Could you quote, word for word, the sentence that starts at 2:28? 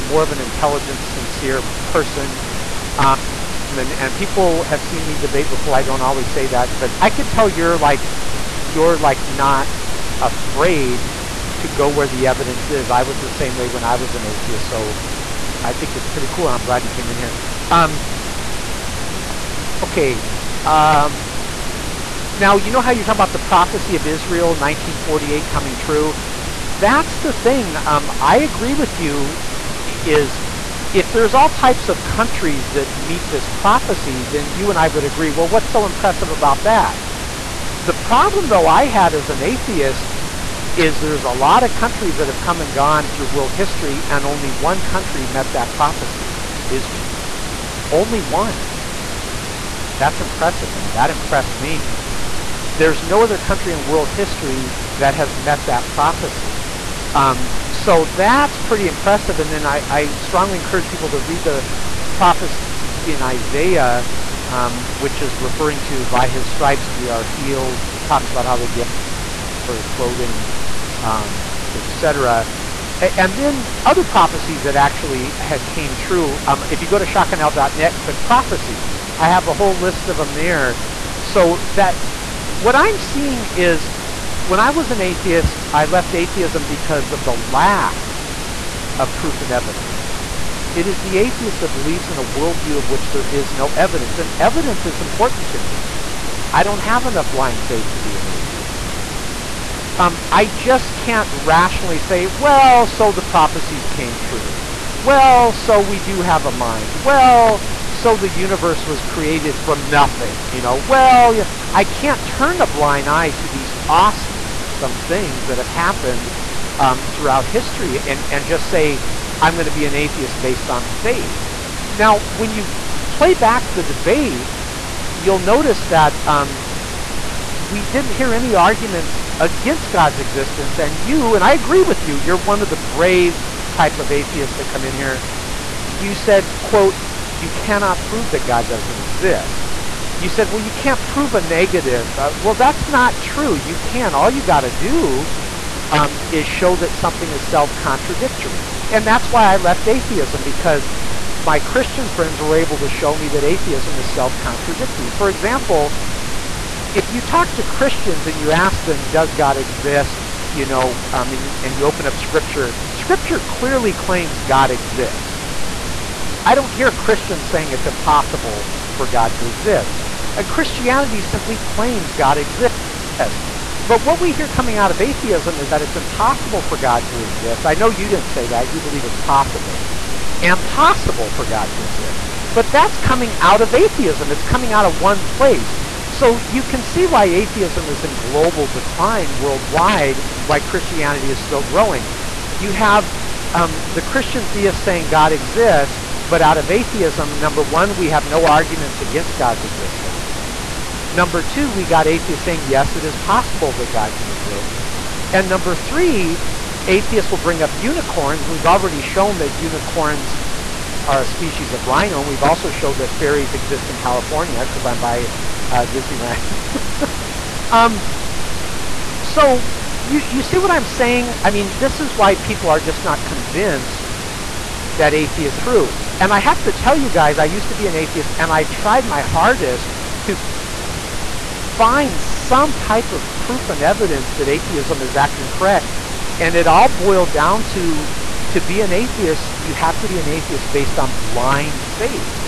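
And that's why I left atheism, because my Christian friends were able to show me that atheism is self-contradictory.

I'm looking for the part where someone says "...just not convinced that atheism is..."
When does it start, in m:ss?
3:42.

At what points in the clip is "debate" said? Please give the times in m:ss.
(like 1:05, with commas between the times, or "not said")
0:05, 2:03.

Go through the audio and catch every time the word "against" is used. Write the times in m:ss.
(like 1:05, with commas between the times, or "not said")
2:09, 3:19.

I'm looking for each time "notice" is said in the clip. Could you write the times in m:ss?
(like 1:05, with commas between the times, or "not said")
2:05.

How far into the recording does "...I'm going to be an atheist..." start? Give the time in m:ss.
1:59.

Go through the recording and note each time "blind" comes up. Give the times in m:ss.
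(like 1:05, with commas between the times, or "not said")
1:37, 1:52, 4:01.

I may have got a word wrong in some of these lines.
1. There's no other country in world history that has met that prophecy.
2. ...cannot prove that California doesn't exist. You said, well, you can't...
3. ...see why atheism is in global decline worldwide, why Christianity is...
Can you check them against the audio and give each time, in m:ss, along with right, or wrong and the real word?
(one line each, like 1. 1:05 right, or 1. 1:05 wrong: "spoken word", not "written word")
1. 0:52 right
2. 2:17 wrong: "God", not "California"
3. 3:06 right.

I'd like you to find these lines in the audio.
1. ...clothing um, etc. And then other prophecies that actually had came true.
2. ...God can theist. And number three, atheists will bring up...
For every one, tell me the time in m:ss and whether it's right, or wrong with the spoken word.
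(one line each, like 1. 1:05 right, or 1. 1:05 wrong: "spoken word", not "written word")
1. 1:09 right
2. 3:23 wrong: "exist", not "theist".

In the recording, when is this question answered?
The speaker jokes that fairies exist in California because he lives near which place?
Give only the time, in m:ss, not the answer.
3:35.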